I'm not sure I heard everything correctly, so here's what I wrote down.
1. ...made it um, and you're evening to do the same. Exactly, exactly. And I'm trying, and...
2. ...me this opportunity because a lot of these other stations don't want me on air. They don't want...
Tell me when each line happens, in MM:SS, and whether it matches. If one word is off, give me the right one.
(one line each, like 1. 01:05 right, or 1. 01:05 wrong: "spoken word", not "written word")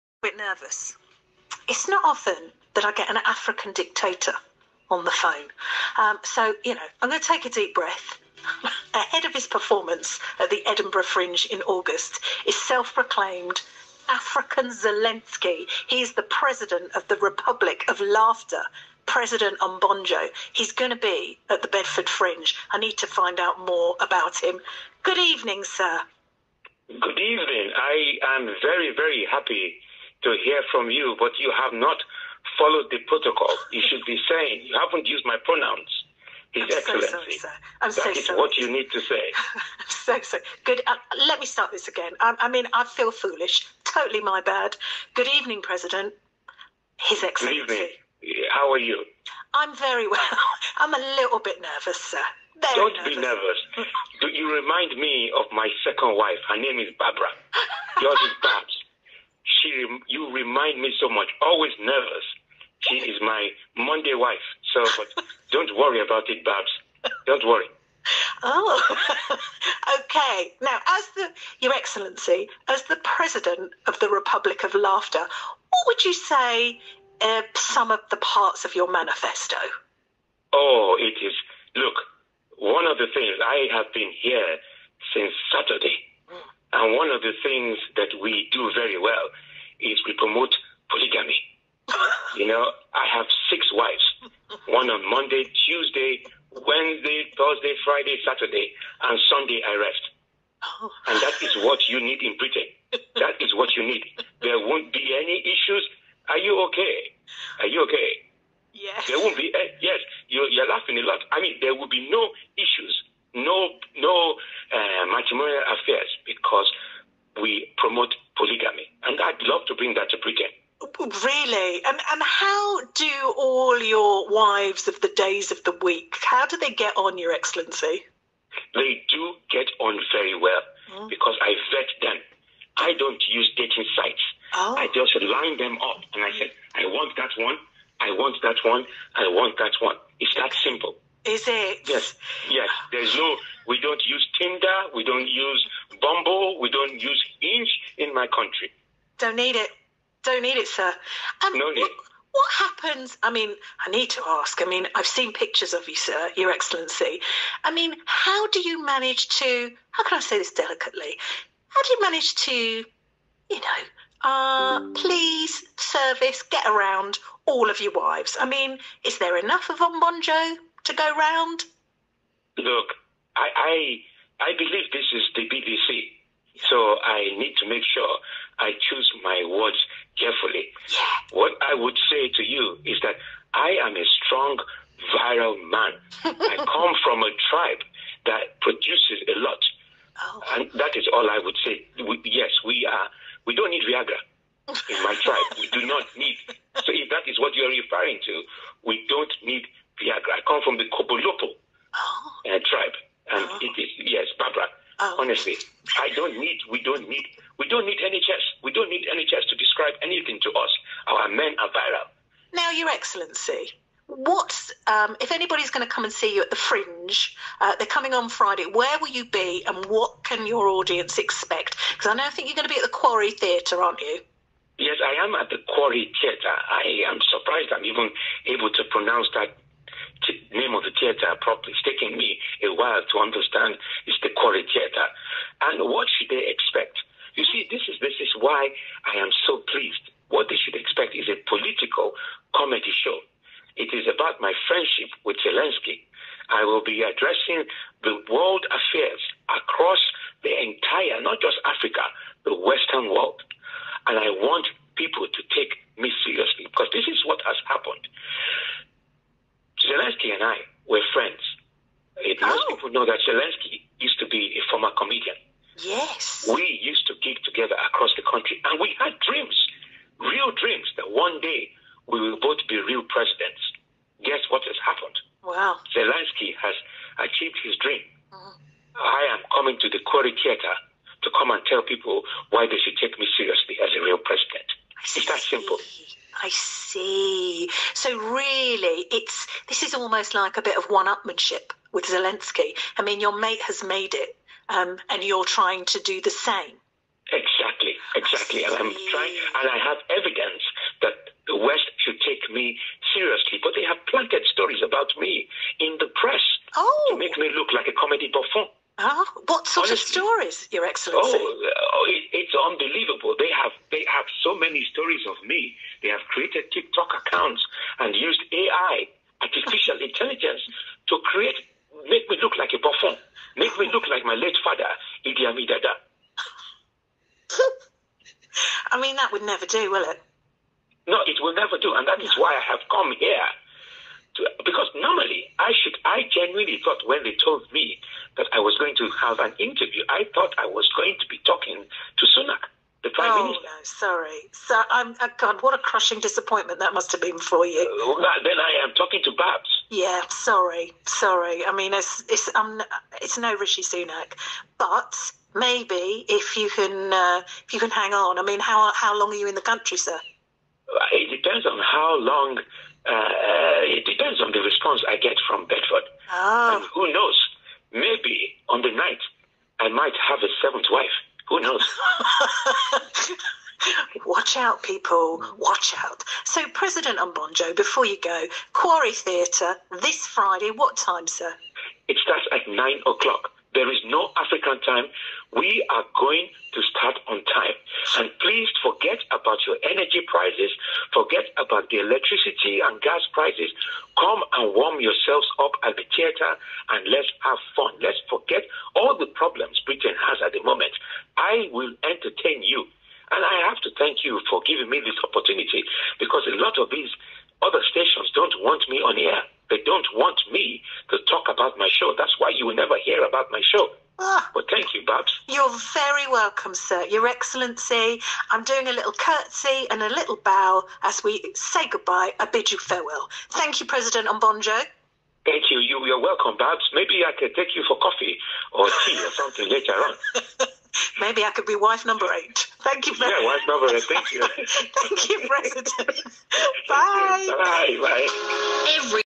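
1. 04:53 wrong: "trying", not "evening"
2. 06:44 right.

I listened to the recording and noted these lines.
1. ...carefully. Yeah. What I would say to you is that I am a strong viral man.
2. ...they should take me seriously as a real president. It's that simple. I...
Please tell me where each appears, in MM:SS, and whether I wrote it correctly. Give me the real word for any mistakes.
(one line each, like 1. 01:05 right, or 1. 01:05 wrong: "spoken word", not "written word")
1. 03:00 right
2. 04:42 right.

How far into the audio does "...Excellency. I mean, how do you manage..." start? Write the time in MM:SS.
02:36.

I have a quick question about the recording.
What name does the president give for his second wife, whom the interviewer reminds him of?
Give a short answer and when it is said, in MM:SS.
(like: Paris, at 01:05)
Barbara, at 00:56.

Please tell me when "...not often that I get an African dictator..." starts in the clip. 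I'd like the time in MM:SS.
00:01.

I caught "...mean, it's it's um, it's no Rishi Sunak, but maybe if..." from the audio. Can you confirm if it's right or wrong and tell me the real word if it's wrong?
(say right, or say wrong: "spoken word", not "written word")
right.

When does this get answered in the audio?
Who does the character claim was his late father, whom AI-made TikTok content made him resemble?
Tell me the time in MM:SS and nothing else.
05:25.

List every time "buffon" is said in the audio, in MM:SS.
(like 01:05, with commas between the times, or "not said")
05:08, 05:22.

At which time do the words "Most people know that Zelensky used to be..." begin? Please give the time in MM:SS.
04:22.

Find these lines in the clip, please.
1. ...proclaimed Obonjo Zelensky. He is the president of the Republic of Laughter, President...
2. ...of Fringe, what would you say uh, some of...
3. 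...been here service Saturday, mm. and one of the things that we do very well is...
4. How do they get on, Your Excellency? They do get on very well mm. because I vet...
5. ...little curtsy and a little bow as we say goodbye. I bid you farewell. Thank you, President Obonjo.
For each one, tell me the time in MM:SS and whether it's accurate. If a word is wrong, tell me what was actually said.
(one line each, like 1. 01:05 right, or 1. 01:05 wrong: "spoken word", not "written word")
1. 00:12 wrong: "African", not "Obonjo"
2. 01:14 wrong: "Laughter", not "Fringe"
3. 01:23 wrong: "since", not "service"
4. 02:06 right
5. 06:58 right.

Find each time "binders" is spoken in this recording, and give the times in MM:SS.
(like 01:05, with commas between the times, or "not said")
not said.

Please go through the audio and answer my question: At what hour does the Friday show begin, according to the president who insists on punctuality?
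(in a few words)
9 o'clock.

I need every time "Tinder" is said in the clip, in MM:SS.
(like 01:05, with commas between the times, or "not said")
02:24.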